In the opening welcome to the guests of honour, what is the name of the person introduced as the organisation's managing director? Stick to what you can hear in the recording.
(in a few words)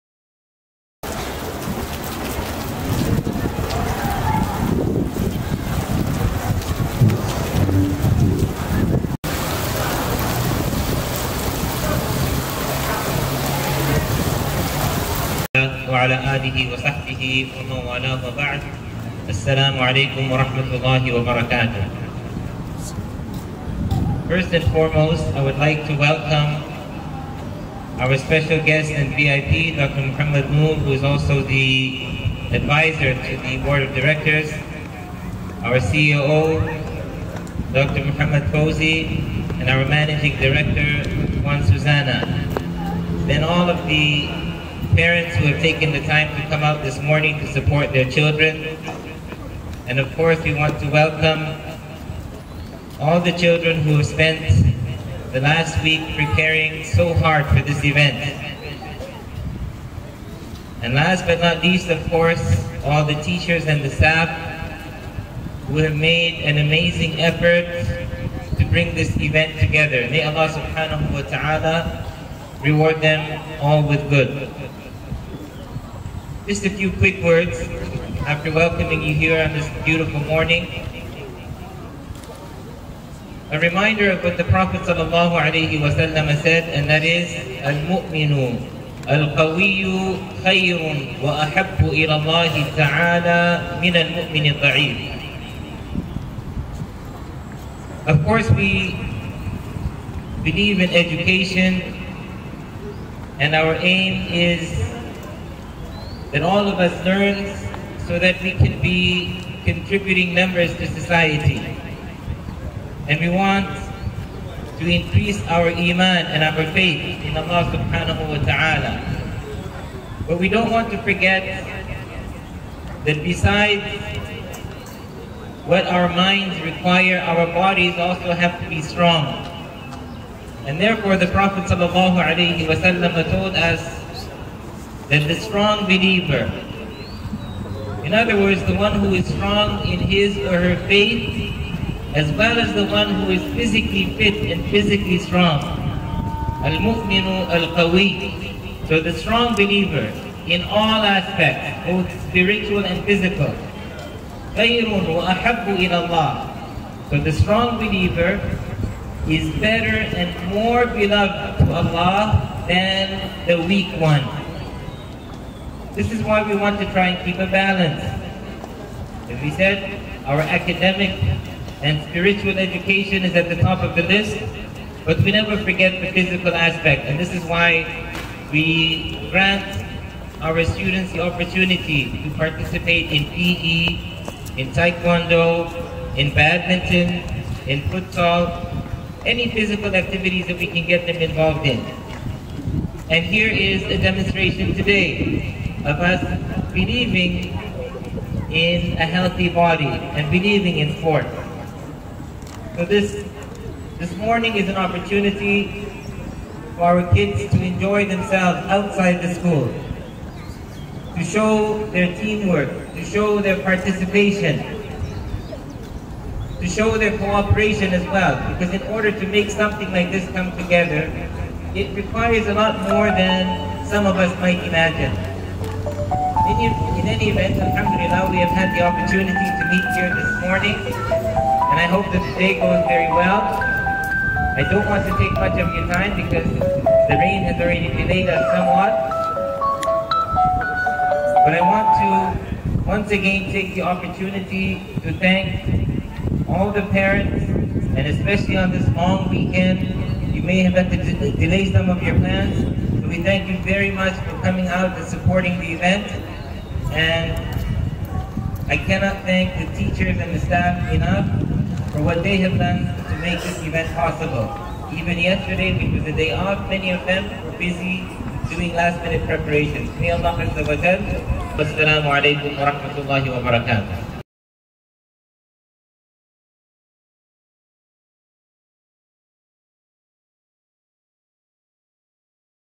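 Juan Susana.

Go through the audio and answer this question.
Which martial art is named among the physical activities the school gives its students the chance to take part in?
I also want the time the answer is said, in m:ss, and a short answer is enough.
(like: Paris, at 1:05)
Taekwondo, at 3:04.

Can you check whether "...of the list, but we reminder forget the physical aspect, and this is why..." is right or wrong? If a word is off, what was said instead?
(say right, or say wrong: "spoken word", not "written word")
wrong: "never", not "reminder".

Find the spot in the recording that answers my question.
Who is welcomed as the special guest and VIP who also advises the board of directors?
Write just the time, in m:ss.
0:29.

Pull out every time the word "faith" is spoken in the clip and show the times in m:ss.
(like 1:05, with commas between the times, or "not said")
1:56, 2:20.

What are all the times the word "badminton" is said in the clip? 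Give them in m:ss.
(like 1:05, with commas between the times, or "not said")
3:06.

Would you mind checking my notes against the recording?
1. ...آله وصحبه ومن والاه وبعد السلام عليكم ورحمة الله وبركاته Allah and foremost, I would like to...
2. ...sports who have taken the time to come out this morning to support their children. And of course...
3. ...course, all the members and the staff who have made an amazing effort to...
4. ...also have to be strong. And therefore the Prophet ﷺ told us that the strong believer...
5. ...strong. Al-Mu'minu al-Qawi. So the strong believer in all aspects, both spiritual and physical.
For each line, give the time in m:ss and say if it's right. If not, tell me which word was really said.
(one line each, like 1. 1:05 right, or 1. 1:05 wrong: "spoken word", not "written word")
1. 0:16 wrong: "First", not "Allah"
2. 0:44 wrong: "parents", not "sports"
3. 1:02 wrong: "teachers", not "members"
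4. 2:07 right
5. 2:25 right.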